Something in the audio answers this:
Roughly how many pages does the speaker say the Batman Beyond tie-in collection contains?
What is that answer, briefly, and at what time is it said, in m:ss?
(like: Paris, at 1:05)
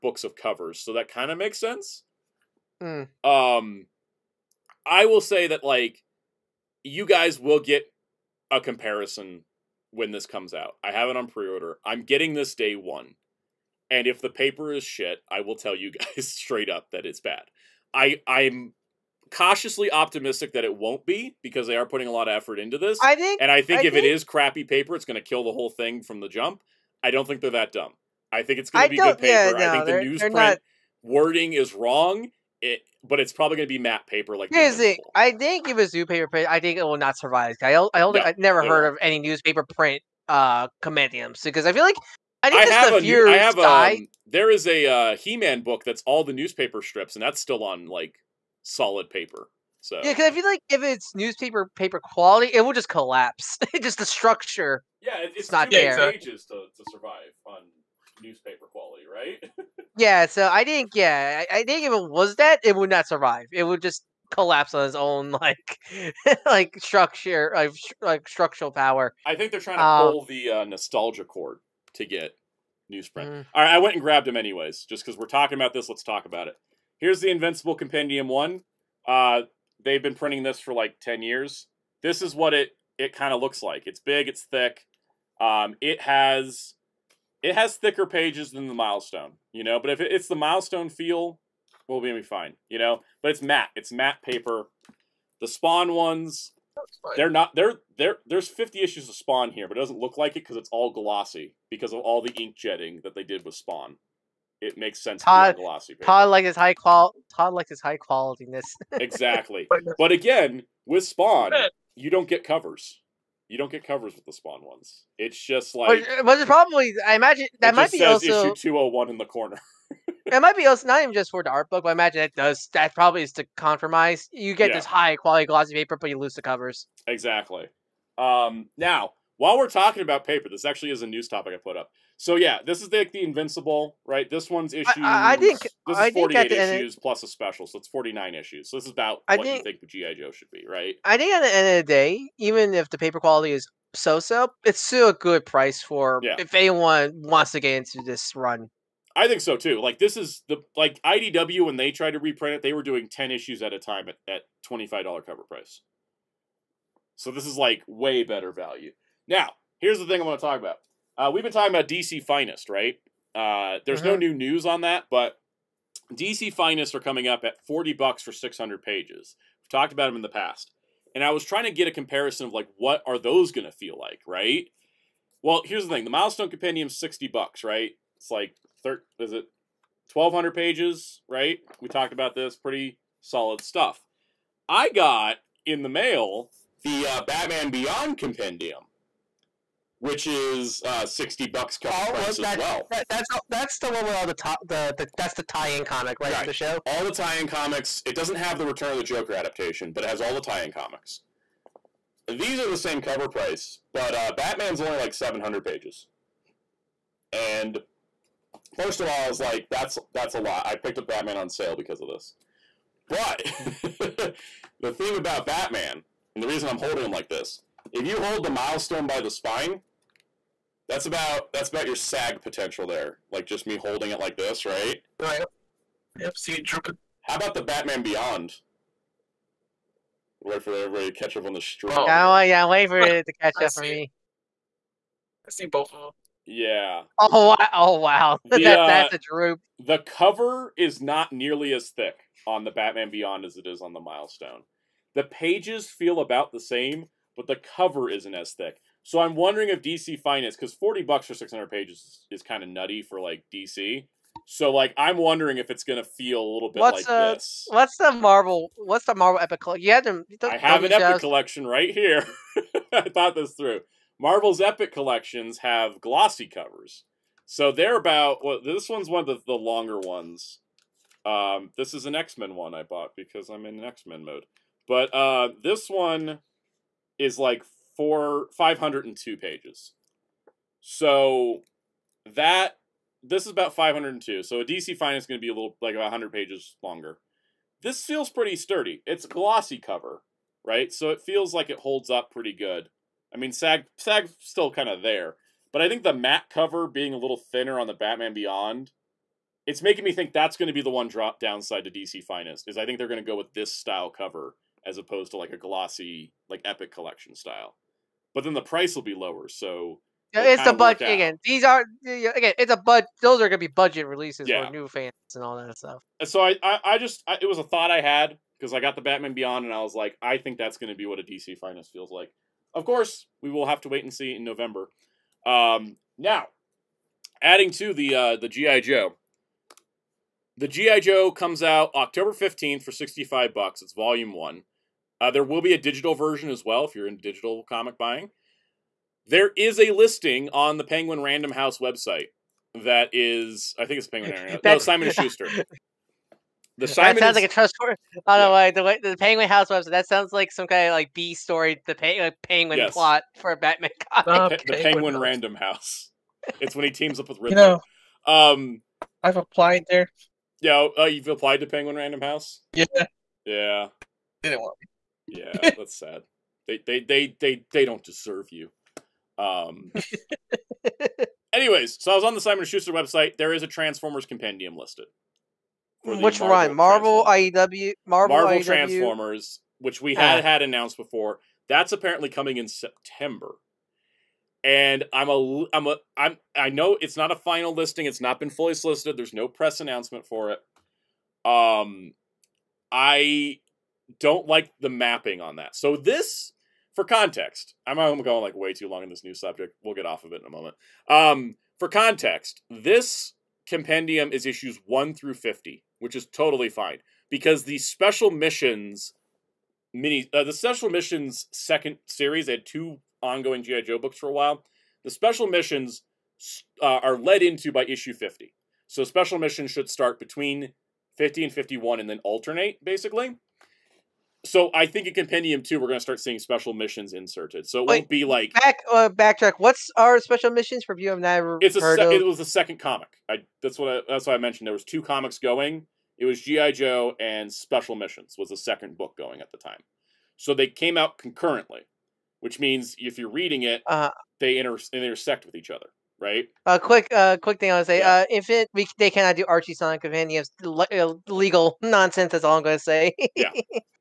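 700, at 3:25.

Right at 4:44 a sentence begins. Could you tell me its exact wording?
So a DC Finest going to be a little like about 100 pages longer.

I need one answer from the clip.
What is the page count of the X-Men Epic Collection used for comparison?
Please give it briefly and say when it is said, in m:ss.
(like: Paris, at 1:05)
502, at 4:38.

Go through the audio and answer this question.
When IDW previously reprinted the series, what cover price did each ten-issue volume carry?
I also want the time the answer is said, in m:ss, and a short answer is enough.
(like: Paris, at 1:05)
$25, at 2:34.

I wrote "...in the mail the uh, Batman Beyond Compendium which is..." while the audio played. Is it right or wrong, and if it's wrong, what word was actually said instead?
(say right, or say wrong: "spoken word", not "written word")
right.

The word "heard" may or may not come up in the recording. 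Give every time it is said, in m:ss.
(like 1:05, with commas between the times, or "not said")
0:38, 7:11.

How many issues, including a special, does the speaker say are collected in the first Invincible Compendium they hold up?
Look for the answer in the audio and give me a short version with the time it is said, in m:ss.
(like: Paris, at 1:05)
49, at 2:17.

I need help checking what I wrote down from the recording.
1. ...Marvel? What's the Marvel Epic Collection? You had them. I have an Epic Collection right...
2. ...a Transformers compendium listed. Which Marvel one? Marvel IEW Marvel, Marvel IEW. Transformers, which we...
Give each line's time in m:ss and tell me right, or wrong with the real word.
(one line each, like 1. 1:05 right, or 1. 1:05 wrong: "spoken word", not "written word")
1. 4:18 right
2. 6:13 right.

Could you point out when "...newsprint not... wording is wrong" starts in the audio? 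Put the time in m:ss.
0:30.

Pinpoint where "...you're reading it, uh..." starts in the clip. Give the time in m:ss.
7:23.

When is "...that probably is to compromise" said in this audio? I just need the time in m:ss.
2:02.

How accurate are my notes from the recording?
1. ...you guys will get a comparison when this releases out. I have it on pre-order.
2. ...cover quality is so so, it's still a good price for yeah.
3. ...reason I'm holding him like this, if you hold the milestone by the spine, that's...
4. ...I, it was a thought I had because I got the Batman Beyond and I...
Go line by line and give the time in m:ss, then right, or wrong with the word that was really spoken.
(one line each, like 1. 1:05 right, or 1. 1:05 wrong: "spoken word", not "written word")
1. 0:06 wrong: "comes", not "releases"
2. 2:22 wrong: "paper", not "cover"
3. 3:36 right
4. 5:17 right.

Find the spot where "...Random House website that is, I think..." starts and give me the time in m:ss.
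5:41.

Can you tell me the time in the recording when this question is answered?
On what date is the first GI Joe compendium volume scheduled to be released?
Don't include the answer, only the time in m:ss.
5:31.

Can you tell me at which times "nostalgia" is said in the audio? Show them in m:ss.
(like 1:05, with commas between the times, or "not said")
1:10.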